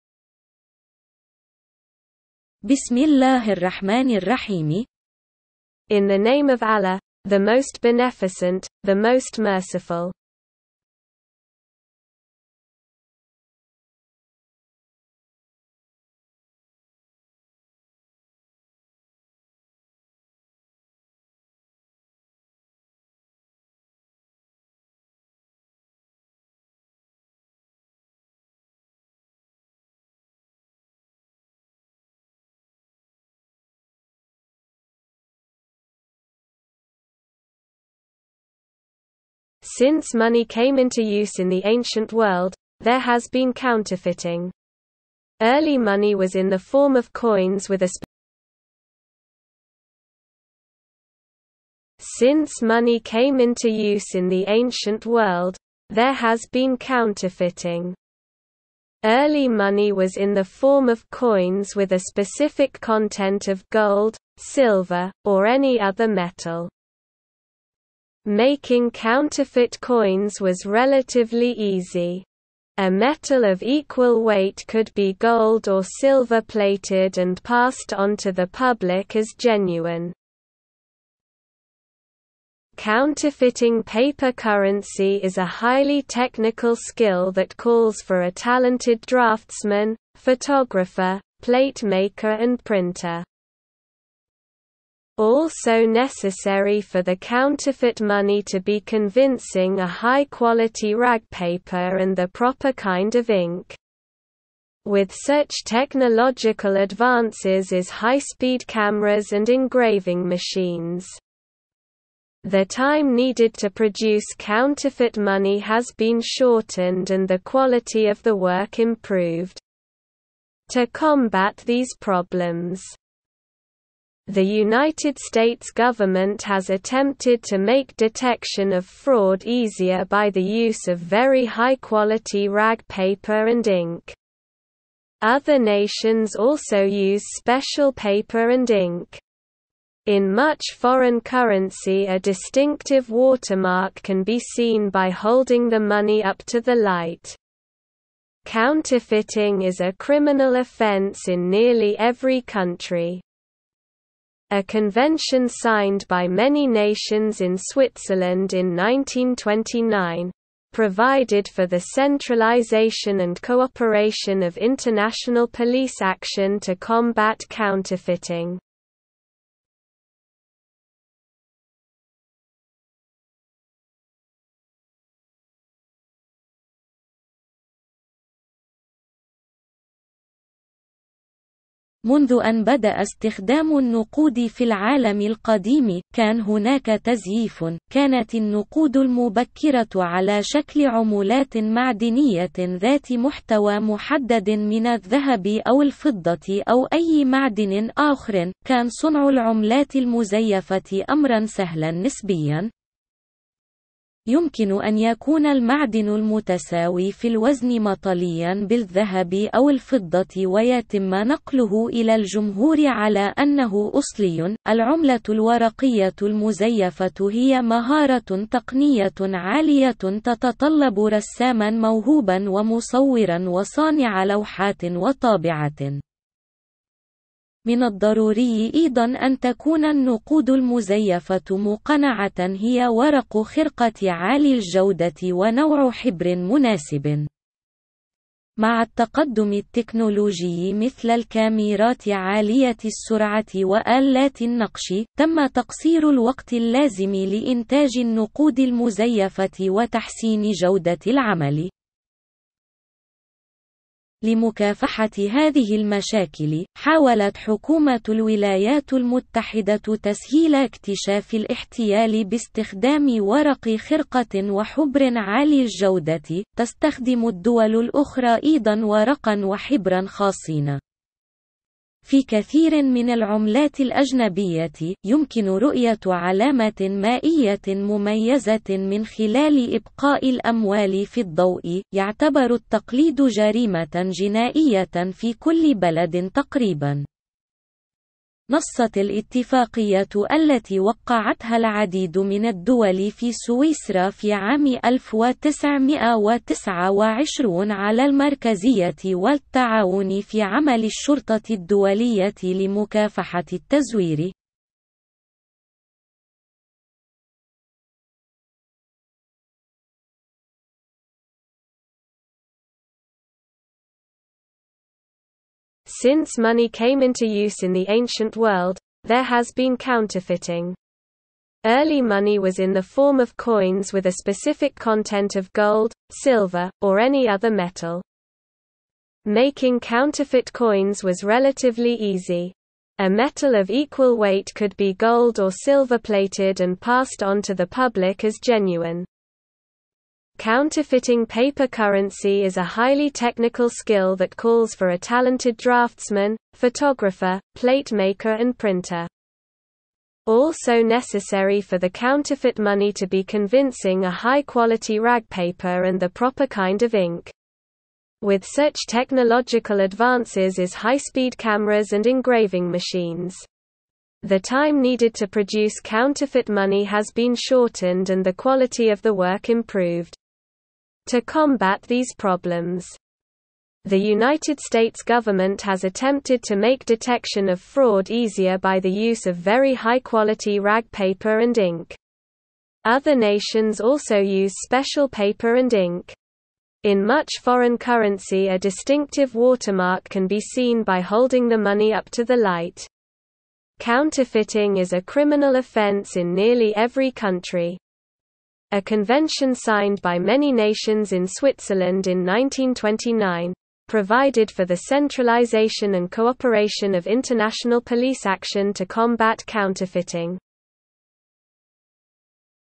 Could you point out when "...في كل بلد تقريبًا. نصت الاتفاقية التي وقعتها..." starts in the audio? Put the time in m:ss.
4:45.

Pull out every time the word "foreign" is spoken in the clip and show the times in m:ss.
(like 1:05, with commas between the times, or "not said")
2:20, 6:27.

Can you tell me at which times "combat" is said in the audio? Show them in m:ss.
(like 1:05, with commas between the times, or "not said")
2:00, 2:46, 6:11, 6:48.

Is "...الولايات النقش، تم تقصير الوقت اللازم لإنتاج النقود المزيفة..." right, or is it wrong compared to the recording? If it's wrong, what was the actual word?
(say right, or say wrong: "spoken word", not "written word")
wrong: "وآلات", not "الولايات".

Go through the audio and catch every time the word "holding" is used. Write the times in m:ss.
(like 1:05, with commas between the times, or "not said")
2:25, 6:31.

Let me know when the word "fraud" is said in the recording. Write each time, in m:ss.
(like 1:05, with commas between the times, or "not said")
2:08, 6:17.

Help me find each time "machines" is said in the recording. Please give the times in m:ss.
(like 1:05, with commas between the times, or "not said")
1:50, 6:02.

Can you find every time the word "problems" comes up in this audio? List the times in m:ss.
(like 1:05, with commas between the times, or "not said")
2:01, 6:12.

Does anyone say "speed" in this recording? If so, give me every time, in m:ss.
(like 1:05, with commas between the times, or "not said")
1:47, 6:00.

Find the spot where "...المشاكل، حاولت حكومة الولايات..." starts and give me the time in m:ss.
4:15.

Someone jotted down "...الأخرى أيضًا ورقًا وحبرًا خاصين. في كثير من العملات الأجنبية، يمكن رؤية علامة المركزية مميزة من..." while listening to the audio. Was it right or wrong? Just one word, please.
wrong.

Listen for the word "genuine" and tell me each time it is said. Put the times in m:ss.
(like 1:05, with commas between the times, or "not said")
1:19, 5:38.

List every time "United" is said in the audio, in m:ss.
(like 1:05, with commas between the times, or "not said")
2:04, 6:13.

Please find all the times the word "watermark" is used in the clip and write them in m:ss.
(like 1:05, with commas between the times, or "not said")
2:23, 6:29.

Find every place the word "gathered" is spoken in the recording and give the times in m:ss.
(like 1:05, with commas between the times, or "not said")
not said.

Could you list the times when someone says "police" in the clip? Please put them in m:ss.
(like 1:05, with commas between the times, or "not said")
2:45, 6:47.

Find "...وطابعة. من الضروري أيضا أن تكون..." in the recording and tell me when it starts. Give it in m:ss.
3:44.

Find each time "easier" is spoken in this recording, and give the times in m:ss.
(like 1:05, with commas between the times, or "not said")
2:09, 6:18.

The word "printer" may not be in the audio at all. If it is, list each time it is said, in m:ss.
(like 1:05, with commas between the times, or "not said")
1:32, 5:48.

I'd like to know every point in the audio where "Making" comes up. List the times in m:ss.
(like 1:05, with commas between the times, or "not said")
1:08, 5:29.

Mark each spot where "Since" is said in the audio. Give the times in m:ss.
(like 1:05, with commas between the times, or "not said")
0:39, 0:52, 5:16.